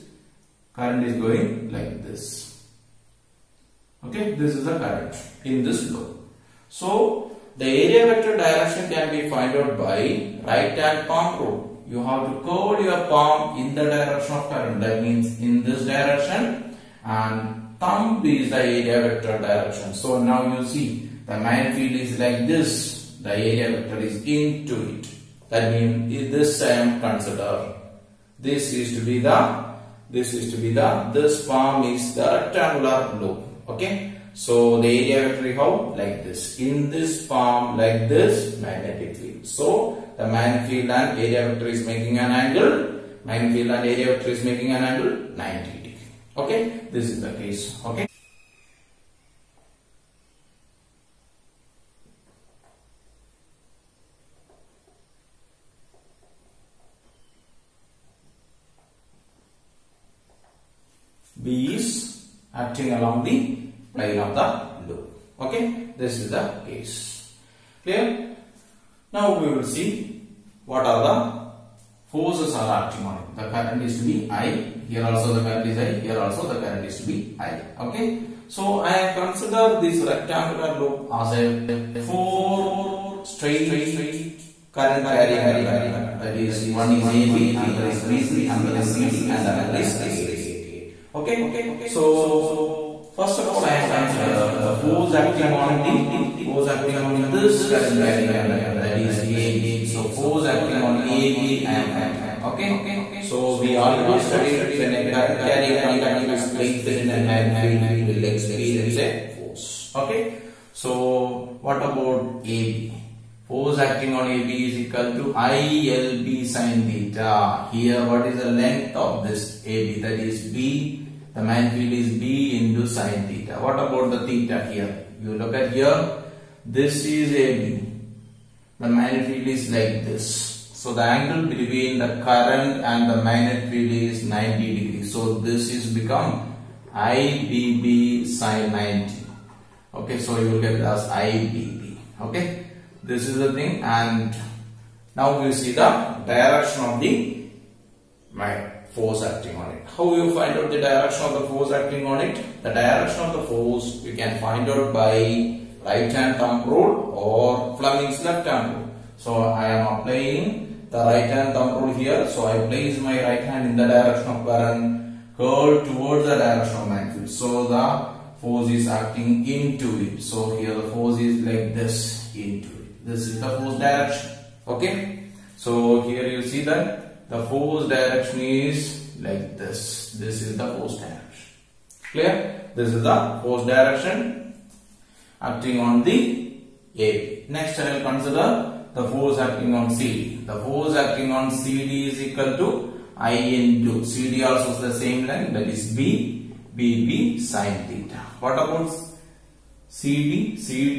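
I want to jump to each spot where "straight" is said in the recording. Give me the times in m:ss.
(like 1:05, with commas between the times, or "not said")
1:23.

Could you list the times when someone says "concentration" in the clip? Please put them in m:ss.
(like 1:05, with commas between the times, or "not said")
not said.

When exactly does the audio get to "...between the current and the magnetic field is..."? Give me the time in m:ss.
2:11.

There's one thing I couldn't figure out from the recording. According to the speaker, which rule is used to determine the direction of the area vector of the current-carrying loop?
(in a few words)
Right hand palm rule.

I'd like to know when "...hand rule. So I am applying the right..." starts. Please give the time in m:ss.
2:38.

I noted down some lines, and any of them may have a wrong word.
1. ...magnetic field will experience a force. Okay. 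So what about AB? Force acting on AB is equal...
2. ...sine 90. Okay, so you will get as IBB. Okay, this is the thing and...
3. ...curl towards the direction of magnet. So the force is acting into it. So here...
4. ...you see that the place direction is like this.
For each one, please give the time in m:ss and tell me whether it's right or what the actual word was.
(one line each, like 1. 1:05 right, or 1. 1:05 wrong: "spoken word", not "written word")
1. 1:47 right
2. 2:18 right
3. 2:45 right
4. 2:56 wrong: "force", not "place".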